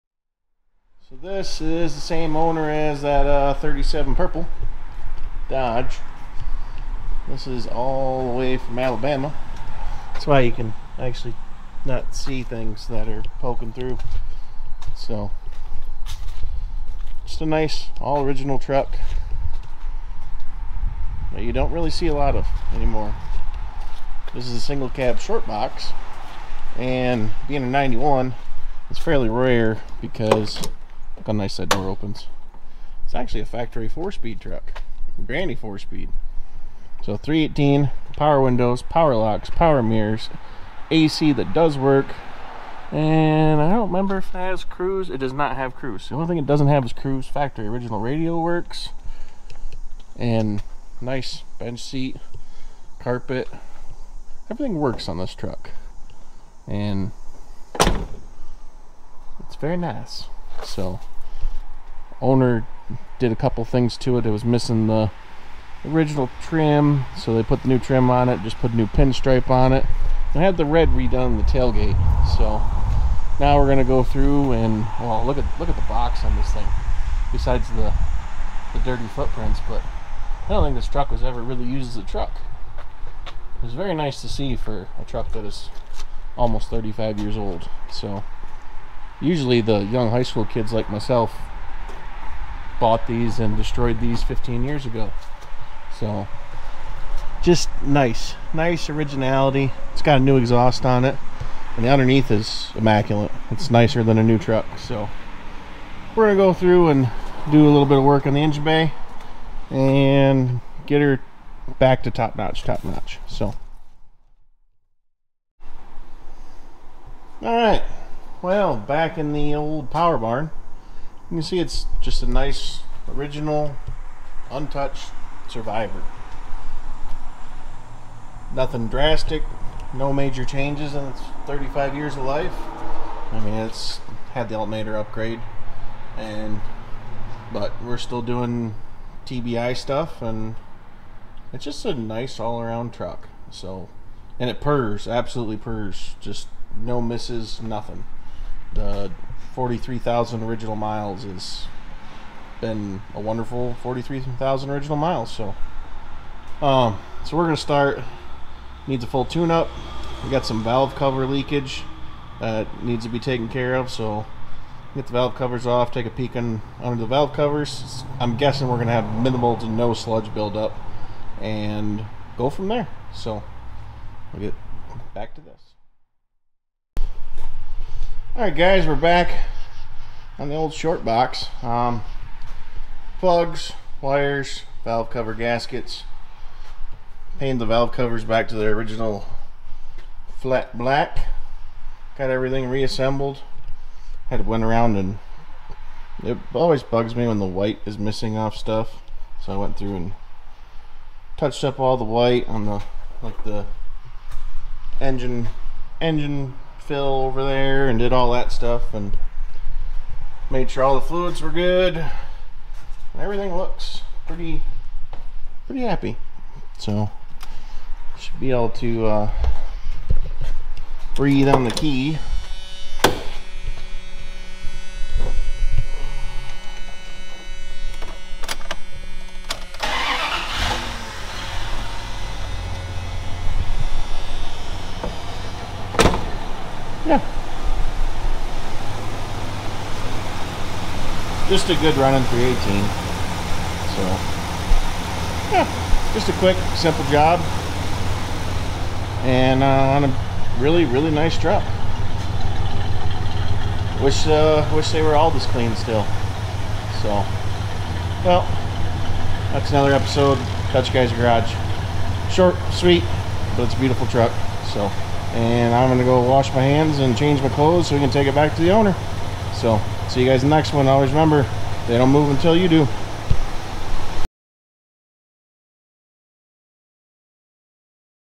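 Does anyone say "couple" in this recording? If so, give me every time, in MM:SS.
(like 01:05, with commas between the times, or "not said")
01:03.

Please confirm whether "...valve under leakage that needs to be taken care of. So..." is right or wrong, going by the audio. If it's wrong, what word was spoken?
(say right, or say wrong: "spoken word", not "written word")
wrong: "cover", not "under".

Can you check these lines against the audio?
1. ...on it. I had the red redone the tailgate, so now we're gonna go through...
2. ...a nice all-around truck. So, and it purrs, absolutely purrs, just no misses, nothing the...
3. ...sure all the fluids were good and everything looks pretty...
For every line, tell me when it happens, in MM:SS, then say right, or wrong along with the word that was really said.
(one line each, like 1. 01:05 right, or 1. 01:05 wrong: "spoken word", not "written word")
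1. 01:09 right
2. 02:21 right
3. 03:30 right.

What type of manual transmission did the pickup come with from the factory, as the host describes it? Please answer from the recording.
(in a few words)
Granny four-speed.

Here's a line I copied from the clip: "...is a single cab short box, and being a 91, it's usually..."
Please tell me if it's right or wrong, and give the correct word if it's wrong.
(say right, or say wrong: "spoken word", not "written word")
wrong: "fairly", not "usually".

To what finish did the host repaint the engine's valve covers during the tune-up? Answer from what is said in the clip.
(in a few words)
Flat black.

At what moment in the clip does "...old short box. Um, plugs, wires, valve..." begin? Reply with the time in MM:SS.
03:00.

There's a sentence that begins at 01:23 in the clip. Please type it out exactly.
It was very nice to see for a truck that is almost 35 years old.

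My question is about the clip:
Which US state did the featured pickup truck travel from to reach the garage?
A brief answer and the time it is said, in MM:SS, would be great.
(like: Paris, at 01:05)
Alabama, at 00:08.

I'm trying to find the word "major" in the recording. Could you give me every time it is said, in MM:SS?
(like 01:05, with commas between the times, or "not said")
02:10.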